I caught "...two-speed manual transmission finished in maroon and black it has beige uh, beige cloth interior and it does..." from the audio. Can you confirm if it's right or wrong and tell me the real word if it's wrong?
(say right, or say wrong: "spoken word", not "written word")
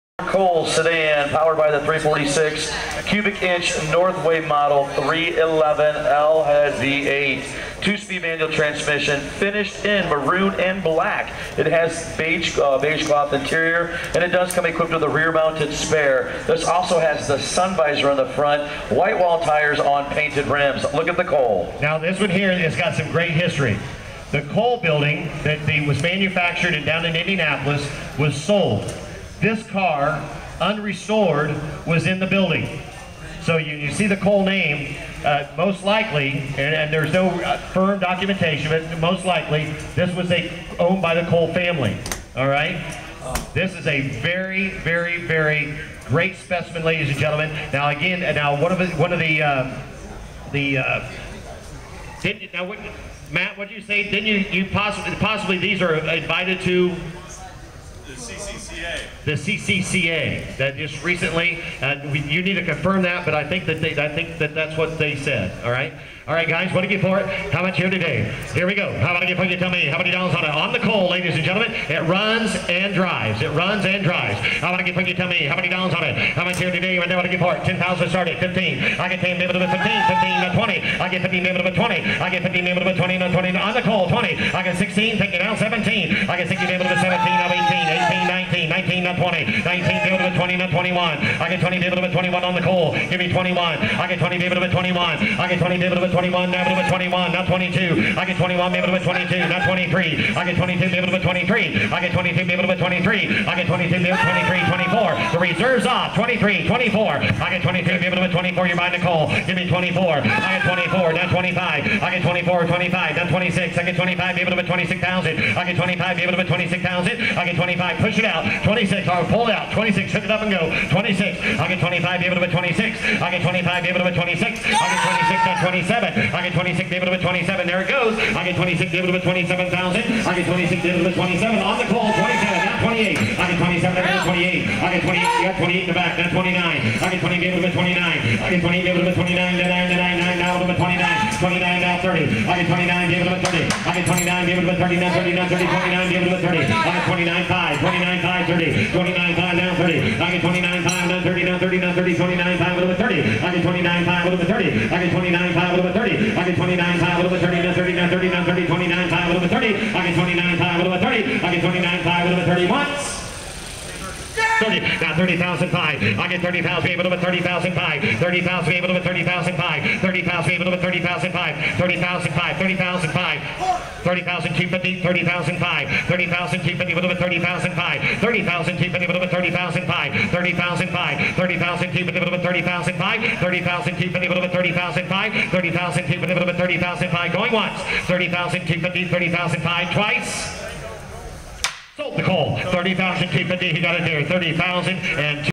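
right.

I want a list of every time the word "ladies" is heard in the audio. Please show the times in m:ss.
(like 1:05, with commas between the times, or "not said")
0:46, 1:11.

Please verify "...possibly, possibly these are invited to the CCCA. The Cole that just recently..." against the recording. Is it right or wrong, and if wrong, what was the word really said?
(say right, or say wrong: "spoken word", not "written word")
wrong: "CCCA", not "Cole".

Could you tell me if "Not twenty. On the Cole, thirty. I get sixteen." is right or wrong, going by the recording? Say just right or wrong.
wrong.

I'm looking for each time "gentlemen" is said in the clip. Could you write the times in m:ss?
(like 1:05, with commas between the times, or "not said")
0:47, 1:11.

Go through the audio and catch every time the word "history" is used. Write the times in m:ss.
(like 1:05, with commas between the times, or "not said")
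0:23.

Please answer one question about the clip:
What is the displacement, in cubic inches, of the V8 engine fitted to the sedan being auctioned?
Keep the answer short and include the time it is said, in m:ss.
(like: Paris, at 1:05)
346, at 0:01.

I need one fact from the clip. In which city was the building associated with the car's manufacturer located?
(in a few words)
Indianapolis.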